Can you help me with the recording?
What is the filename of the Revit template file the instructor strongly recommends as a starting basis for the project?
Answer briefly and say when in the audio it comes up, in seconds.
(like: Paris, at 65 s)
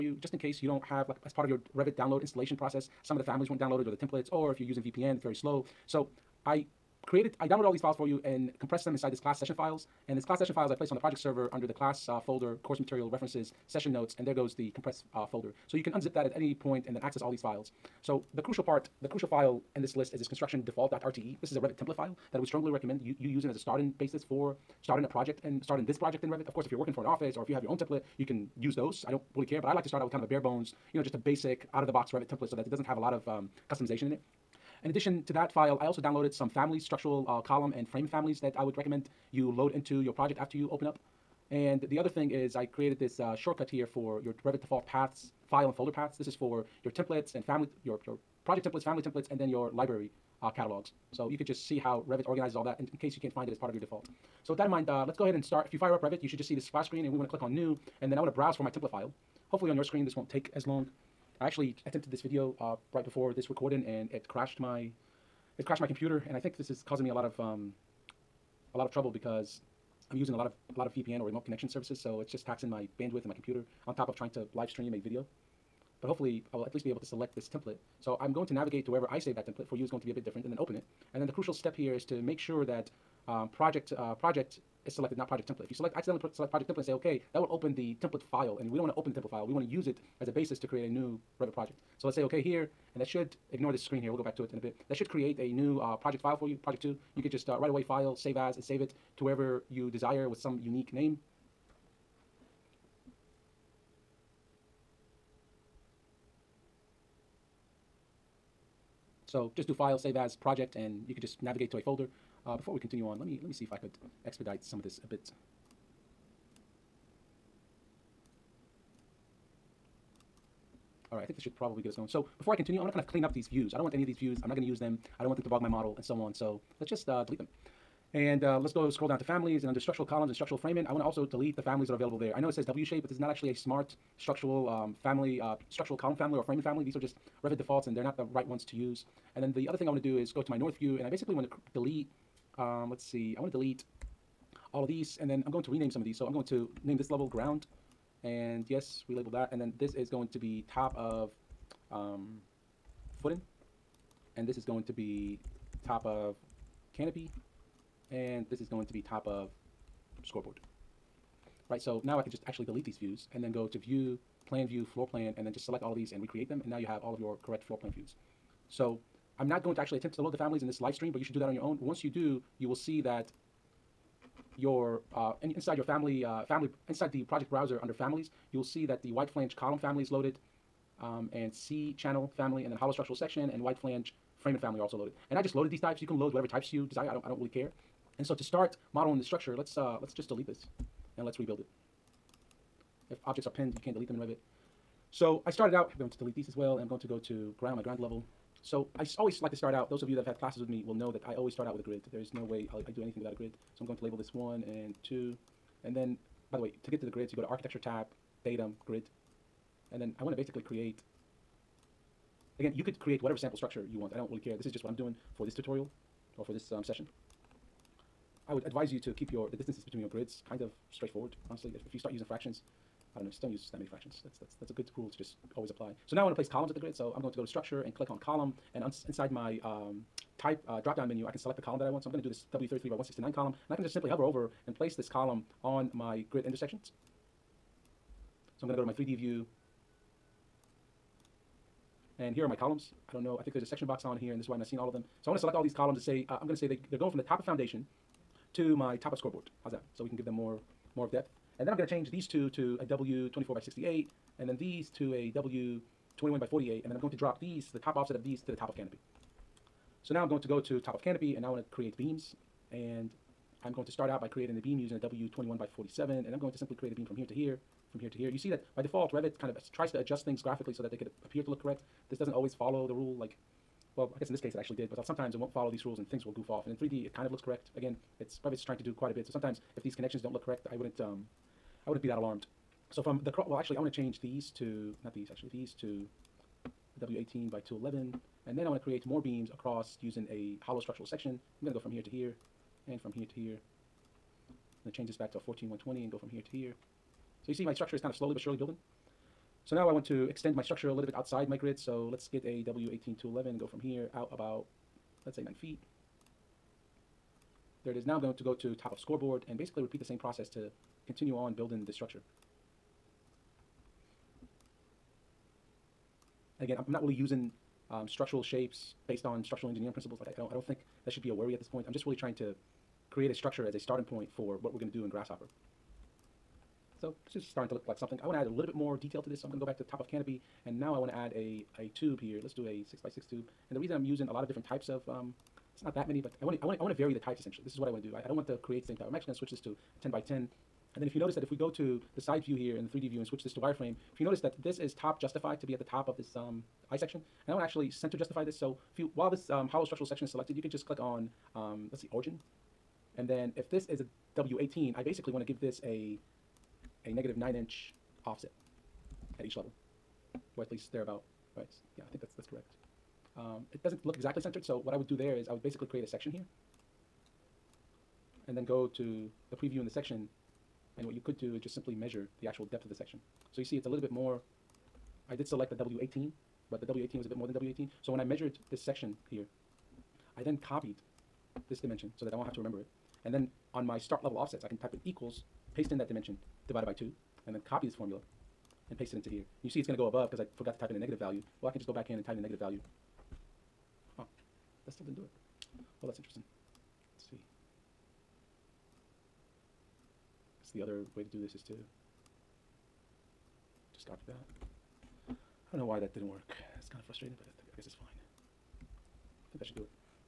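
construction default.rte, at 20 s.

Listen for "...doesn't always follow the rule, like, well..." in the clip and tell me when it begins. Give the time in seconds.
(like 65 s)
272 s.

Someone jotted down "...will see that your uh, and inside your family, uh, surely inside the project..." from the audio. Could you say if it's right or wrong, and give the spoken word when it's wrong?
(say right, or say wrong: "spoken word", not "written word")
wrong: "family", not "surely".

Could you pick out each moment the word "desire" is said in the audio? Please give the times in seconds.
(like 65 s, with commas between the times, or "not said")
99 s, 186 s.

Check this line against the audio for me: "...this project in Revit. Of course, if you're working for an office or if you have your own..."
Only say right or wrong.
right.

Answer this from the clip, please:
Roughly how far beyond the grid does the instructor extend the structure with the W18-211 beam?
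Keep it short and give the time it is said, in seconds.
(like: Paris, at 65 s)
9 feet, at 305 s.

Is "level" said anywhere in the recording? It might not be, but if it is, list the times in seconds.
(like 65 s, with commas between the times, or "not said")
147 s, 197 s, 359 s, 384 s.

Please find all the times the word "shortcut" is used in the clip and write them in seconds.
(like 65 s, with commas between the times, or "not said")
43 s.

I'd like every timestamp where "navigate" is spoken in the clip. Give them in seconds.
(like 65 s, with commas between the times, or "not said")
78 s, 111 s.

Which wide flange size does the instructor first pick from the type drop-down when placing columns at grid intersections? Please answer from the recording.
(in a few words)
W33x169.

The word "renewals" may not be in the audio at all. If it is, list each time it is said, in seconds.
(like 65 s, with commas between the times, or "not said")
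not said.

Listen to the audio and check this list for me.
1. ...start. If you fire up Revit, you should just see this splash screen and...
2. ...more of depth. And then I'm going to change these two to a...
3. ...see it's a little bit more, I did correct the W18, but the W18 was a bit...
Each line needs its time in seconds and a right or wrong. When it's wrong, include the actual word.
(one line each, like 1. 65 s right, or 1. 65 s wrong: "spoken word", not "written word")
1. 55 s right
2. 250 s right
3. 373 s wrong: "select", not "correct".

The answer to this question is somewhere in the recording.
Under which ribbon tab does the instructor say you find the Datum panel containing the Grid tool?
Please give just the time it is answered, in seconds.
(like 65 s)
207 s.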